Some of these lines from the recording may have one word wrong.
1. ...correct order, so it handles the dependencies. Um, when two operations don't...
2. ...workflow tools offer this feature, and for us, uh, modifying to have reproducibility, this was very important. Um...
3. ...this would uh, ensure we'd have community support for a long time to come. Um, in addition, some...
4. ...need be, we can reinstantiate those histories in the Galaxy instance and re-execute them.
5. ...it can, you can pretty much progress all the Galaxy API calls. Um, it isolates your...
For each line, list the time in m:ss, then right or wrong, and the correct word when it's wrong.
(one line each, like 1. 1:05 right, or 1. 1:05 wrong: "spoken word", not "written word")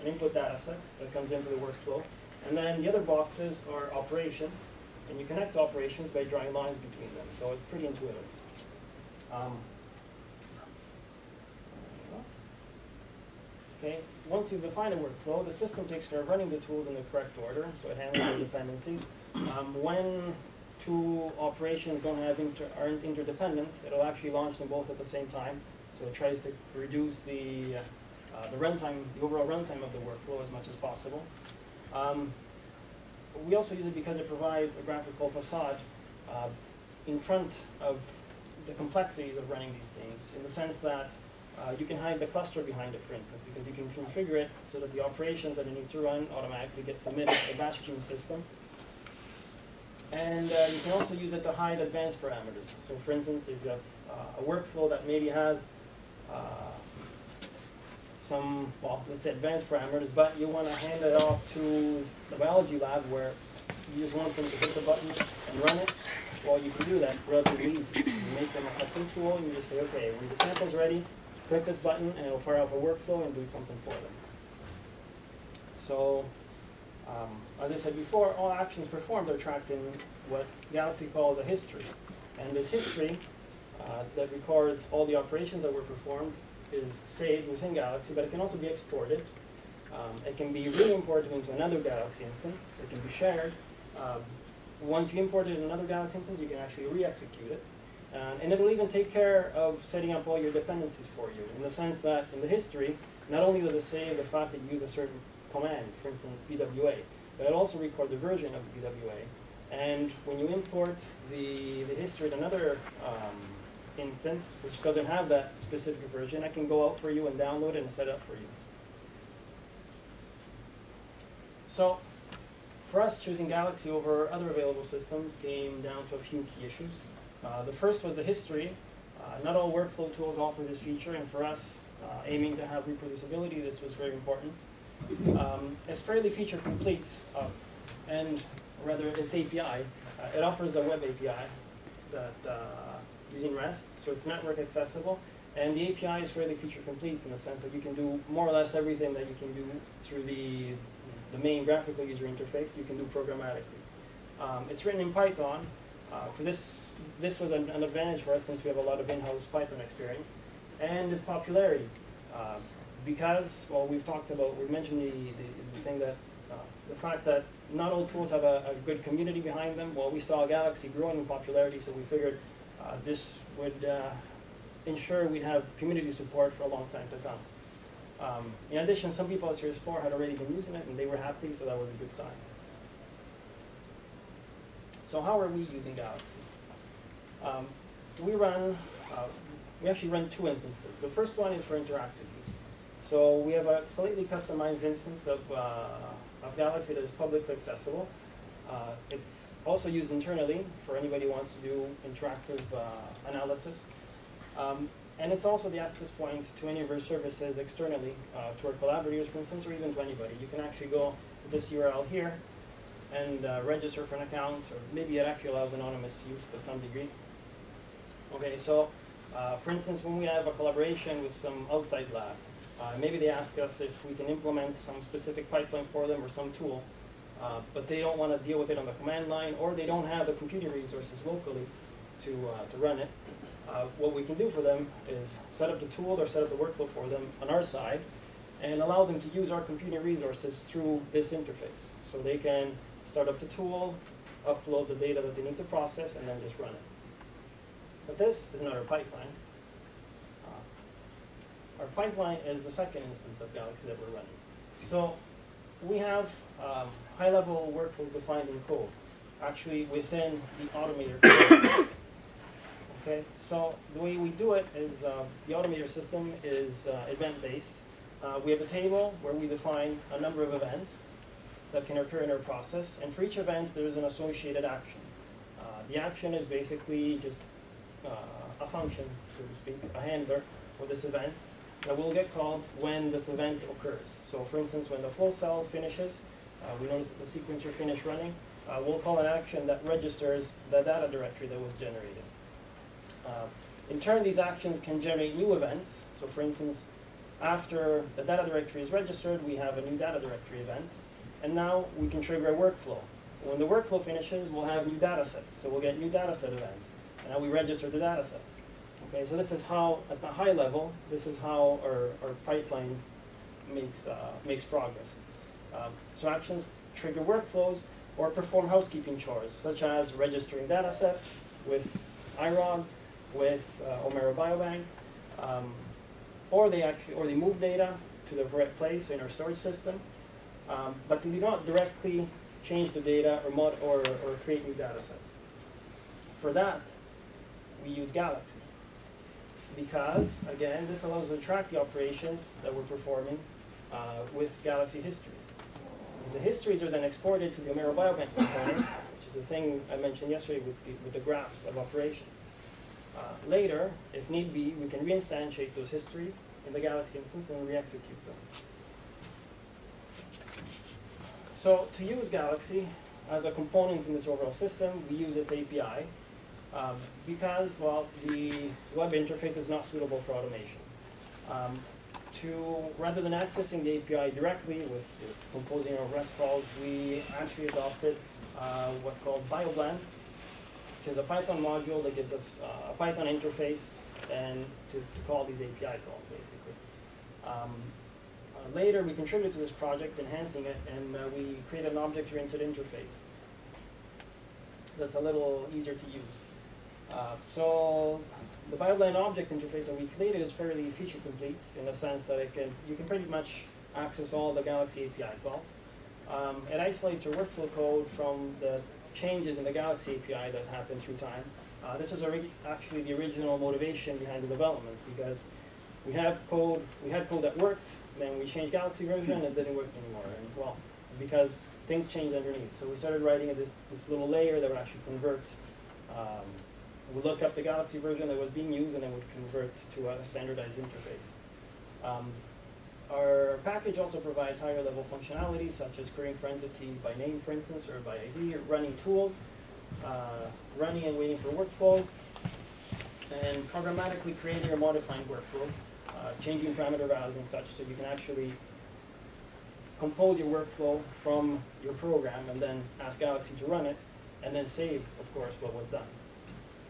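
1. 0:17 right
2. 2:09 wrong: "aiming", not "modifying"
3. 2:53 right
4. 5:54 right
5. 6:42 wrong: "access", not "progress".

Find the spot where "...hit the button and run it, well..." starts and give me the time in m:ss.
1:04.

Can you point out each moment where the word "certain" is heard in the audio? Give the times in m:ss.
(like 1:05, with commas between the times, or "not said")
1:44.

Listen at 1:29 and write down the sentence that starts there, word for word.
Um, it can be re-imported into another Galaxy instance.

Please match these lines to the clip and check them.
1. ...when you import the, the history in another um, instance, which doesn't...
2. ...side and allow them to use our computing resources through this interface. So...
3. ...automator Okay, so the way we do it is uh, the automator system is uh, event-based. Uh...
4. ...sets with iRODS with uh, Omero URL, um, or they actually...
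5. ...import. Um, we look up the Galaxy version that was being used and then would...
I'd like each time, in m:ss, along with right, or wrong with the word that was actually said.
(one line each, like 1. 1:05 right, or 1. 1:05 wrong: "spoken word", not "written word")
1. 1:50 right
2. 3:57 right
3. 4:20 right
4. 5:20 wrong: "Biobank", not "URL"
5. 7:05 wrong: "convert", not "import".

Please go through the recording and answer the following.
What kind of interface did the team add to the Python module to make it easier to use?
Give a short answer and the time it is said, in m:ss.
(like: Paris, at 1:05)
Object-oriented interface, at 6:31.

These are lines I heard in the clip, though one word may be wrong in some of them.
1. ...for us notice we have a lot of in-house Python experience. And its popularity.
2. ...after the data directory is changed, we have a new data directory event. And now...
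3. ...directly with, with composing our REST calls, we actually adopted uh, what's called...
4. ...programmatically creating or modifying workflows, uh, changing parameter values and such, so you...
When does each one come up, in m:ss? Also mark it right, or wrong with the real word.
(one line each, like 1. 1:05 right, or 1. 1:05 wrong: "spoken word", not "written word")
1. 2:38 wrong: "since", not "notice"
2. 4:57 wrong: "registered", not "changed"
3. 6:14 right
4. 7:23 right.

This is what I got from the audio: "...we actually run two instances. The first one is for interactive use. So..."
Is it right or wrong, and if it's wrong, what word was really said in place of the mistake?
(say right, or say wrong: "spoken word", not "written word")
right.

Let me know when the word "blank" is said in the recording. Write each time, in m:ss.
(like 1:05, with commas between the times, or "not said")
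not said.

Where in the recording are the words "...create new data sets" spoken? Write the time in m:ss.
5:34.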